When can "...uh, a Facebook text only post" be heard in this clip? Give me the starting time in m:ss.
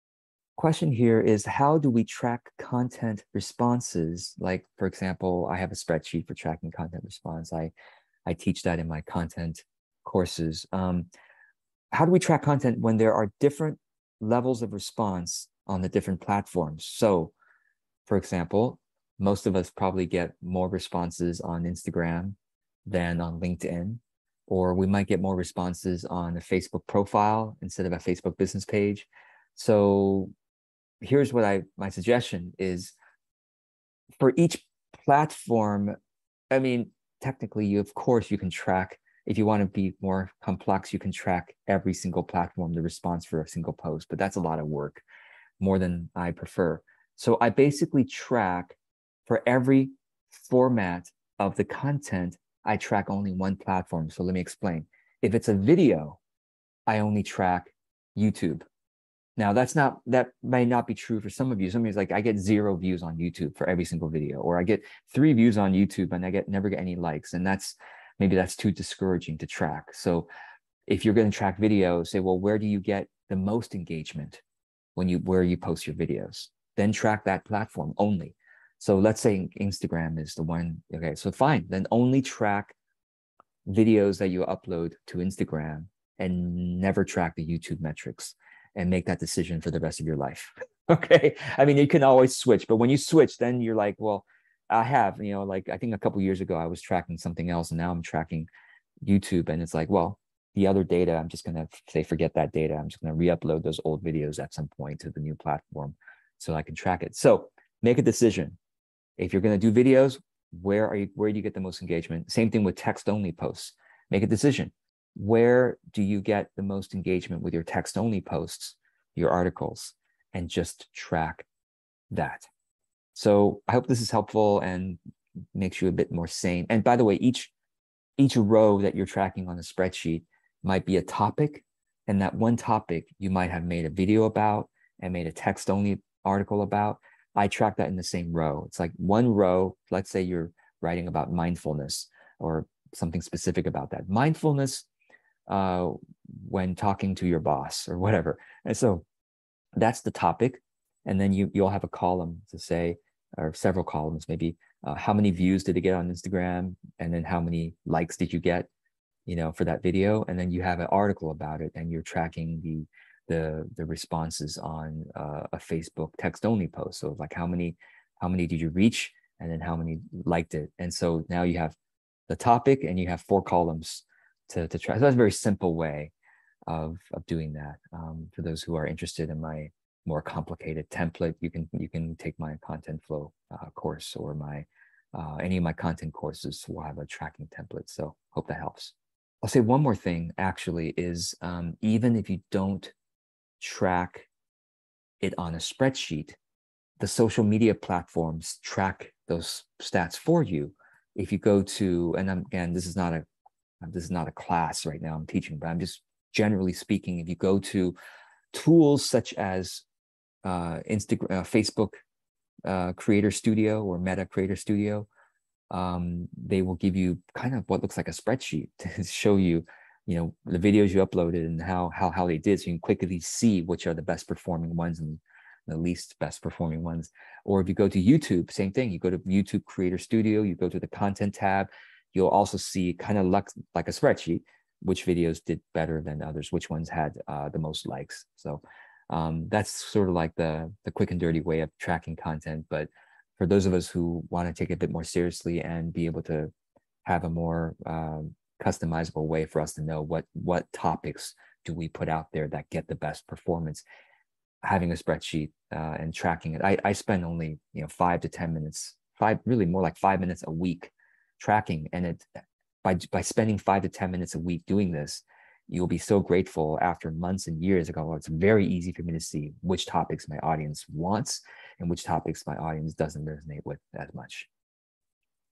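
2:45.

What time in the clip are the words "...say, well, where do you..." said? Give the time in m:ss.
1:12.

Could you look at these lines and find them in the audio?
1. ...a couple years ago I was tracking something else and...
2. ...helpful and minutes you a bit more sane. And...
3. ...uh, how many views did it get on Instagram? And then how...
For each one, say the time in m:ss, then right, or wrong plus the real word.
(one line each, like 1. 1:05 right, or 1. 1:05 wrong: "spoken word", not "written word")
1. 1:35 right
2. 2:04 wrong: "makes", not "minutes"
3. 2:34 right.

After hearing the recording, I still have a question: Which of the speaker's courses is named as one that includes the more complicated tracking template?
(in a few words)
Content Flow.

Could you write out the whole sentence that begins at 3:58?
So um, that's sort of like the, the quick and dirty way of tracking content.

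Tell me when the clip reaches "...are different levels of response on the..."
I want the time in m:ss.
0:13.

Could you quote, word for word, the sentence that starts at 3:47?
Or if you go to YouTube, same thing.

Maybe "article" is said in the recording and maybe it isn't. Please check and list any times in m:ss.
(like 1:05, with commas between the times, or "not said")
1:59, 2:16, 2:40.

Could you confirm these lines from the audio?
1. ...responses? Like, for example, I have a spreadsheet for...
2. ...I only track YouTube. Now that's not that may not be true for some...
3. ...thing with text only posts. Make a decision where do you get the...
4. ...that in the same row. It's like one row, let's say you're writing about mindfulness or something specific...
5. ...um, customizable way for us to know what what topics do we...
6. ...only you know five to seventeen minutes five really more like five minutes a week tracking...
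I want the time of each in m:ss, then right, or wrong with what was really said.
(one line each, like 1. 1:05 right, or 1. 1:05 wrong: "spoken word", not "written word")
1. 0:03 right
2. 0:56 right
3. 1:52 right
4. 2:17 right
5. 4:07 right
6. 4:17 wrong: "ten", not "seventeen".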